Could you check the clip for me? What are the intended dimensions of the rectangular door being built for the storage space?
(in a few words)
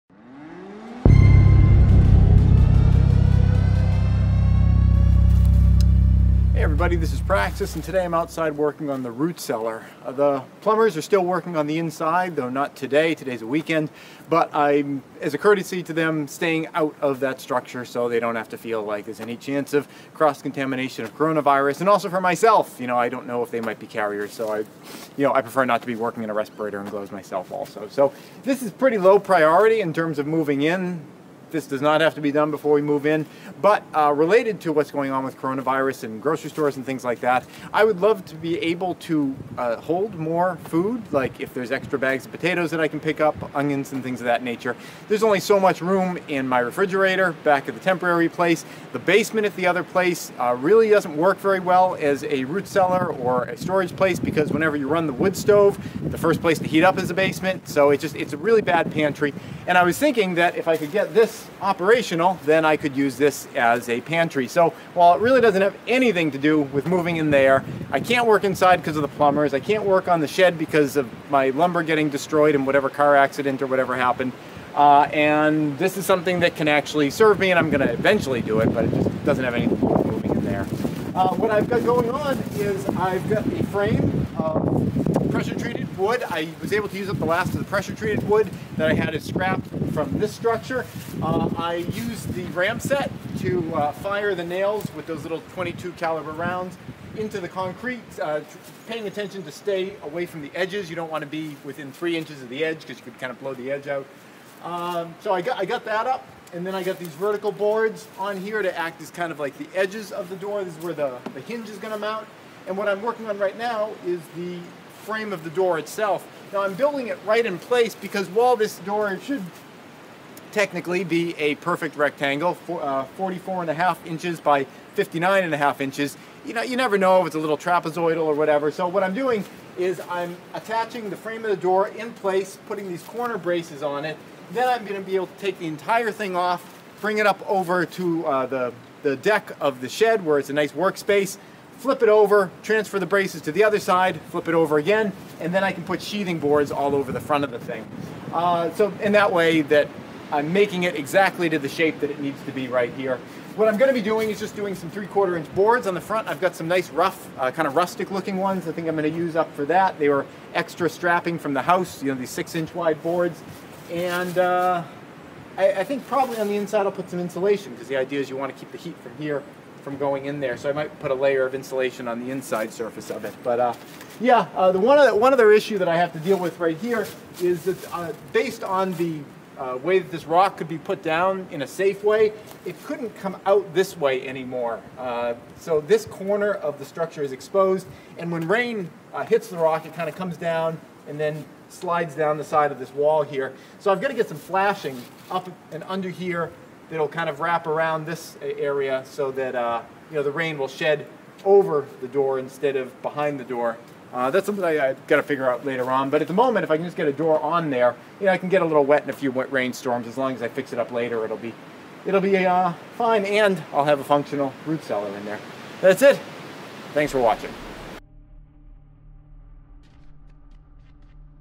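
44.5 by 59.5 inches.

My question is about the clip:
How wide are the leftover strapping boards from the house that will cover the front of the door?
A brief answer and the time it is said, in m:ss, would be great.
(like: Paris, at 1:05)
6 inches, at 2:42.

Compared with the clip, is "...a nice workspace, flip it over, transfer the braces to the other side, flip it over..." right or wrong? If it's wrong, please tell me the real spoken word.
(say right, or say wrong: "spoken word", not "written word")
right.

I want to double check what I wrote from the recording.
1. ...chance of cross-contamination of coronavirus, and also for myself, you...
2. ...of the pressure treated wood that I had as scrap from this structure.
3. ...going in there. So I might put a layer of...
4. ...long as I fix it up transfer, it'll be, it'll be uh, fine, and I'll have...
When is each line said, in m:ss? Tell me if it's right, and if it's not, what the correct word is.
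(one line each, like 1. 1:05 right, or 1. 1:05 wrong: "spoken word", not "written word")
1. 0:19 right
2. 1:27 right
3. 2:49 right
4. 3:30 wrong: "later", not "transfer".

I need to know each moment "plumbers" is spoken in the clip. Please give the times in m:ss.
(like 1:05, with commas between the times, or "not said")
0:10, 1:09.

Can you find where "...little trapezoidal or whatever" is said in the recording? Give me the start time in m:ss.
2:07.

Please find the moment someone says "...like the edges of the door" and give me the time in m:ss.
1:49.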